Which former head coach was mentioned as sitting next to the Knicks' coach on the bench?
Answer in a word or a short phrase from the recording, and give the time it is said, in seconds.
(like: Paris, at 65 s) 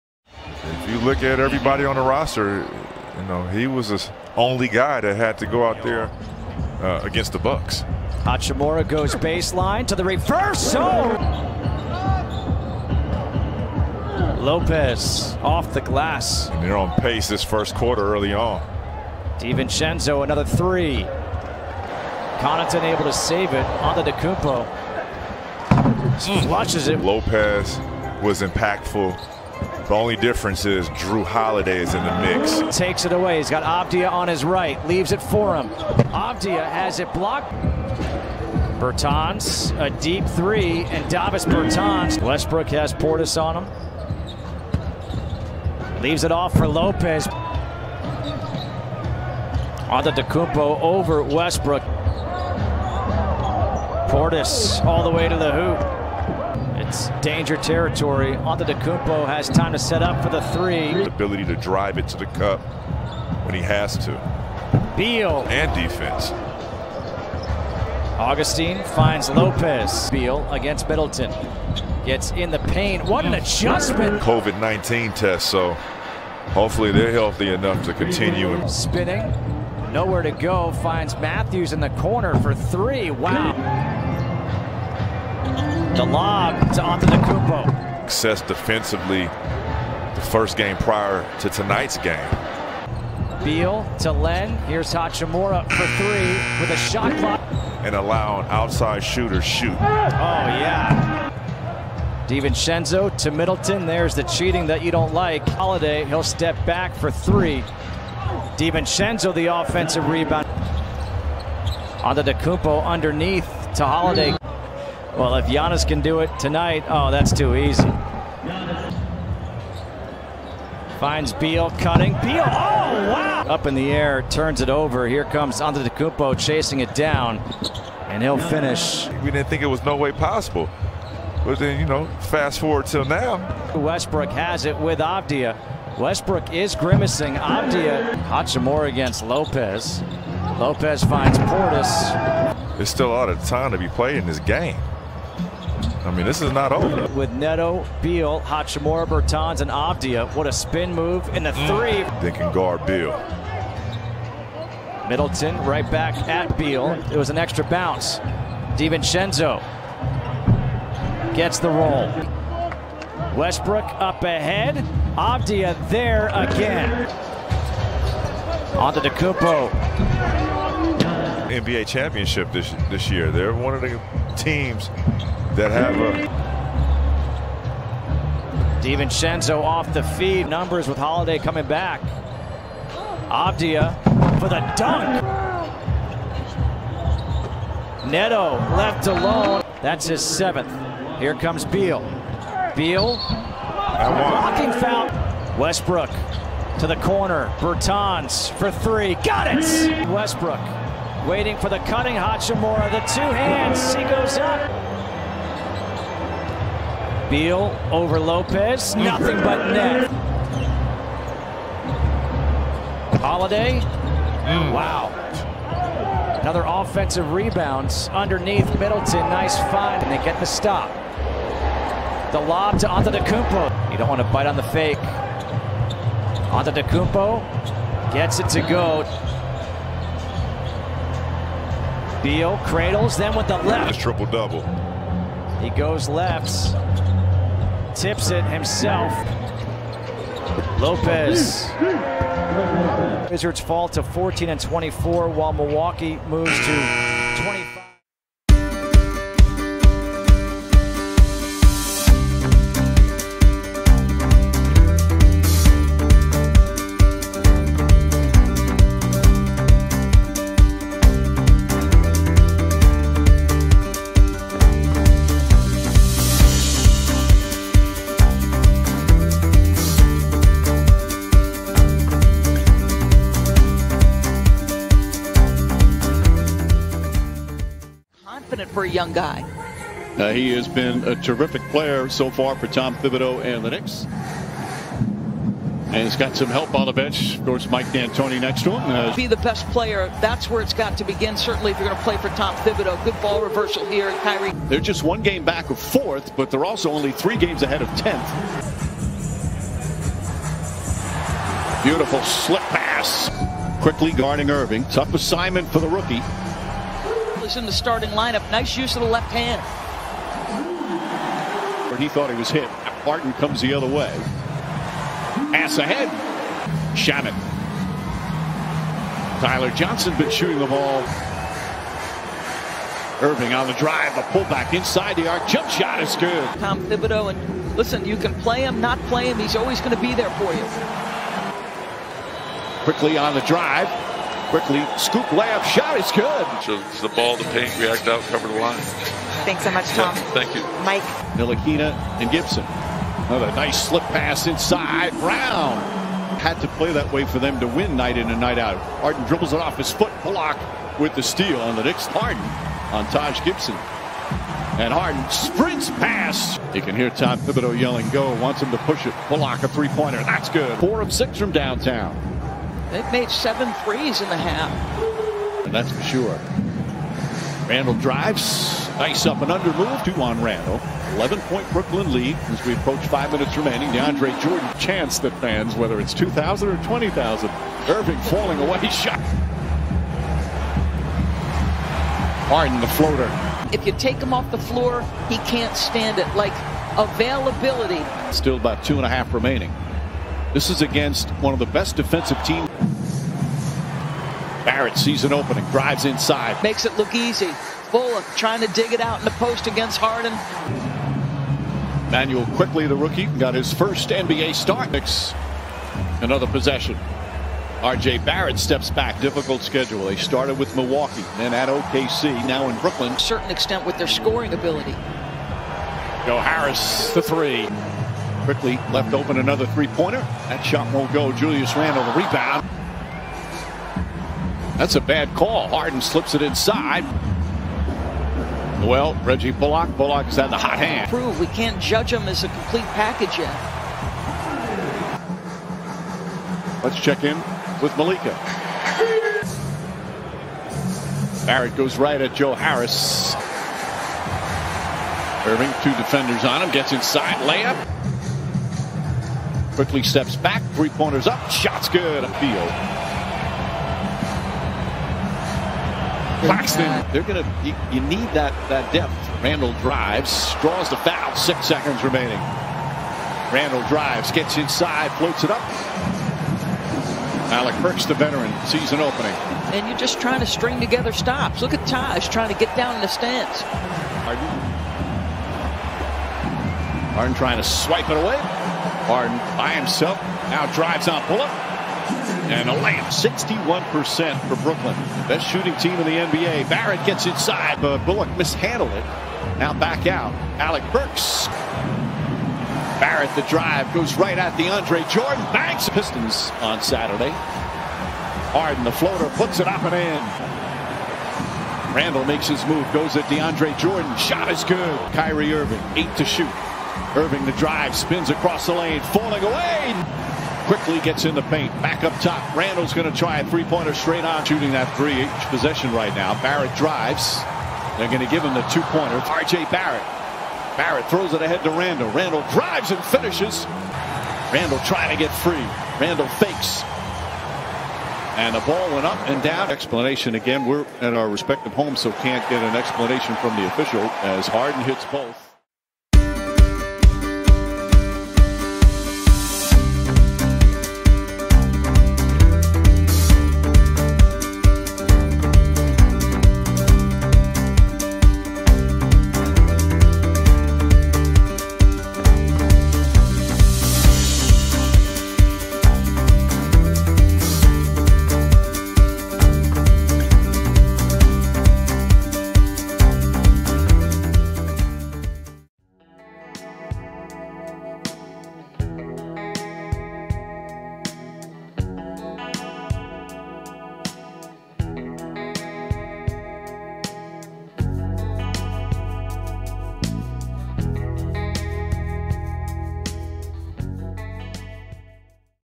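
Mike D'Antoni, at 287 s.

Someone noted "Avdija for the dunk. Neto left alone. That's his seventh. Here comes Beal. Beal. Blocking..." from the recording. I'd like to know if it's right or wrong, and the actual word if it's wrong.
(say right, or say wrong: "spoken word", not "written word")
right.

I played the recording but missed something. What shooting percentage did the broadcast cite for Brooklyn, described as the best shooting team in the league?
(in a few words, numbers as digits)
61%.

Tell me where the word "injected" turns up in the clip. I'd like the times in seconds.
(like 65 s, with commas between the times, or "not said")
not said.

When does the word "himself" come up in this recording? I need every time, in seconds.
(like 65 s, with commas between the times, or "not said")
238 s, 479 s.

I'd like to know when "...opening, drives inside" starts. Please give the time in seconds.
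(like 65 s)
395 s.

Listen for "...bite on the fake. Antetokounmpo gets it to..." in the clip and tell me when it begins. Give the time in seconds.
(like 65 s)
224 s.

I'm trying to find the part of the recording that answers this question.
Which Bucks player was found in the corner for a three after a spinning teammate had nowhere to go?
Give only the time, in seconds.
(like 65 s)
81 s.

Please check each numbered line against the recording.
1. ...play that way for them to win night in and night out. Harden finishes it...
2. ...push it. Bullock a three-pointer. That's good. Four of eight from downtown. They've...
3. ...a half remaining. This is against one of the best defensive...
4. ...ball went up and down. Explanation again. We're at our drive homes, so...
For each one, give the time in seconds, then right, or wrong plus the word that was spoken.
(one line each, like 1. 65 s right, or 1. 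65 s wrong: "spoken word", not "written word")
1. 346 s wrong: "dribbles", not "finishes"
2. 358 s wrong: "six", not "eight"
3. 389 s right
4. 528 s wrong: "respective", not "drive".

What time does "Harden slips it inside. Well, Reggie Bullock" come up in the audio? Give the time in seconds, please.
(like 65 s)
425 s.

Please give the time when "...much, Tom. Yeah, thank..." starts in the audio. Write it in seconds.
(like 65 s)
339 s.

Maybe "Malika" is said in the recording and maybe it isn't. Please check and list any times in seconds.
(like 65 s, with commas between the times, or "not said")
437 s.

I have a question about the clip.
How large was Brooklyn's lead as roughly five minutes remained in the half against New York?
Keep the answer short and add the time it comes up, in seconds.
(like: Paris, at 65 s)
11 points, at 371 s.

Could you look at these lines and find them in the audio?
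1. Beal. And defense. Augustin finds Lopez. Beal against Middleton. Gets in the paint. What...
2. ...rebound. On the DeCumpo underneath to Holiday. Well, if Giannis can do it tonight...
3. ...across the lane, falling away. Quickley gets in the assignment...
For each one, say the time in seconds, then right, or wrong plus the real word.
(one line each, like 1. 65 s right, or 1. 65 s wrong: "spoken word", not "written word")
1. 64 s right
2. 110 s right
3. 508 s wrong: "paint", not "assignment".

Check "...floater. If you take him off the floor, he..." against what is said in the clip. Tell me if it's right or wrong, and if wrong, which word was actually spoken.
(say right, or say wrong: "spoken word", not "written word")
right.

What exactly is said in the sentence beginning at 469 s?
And you're just trying to string together stops.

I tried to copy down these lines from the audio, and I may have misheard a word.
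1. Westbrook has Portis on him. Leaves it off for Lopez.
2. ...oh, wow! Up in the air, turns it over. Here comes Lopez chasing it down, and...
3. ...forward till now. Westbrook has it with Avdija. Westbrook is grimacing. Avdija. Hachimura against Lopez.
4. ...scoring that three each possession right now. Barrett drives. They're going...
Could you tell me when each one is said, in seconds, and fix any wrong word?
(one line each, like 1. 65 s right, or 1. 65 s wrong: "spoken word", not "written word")
1. 42 s right
2. 122 s wrong: "Antetokounmpo", not "Lopez"
3. 132 s right
4. 514 s wrong: "shooting", not "scoring".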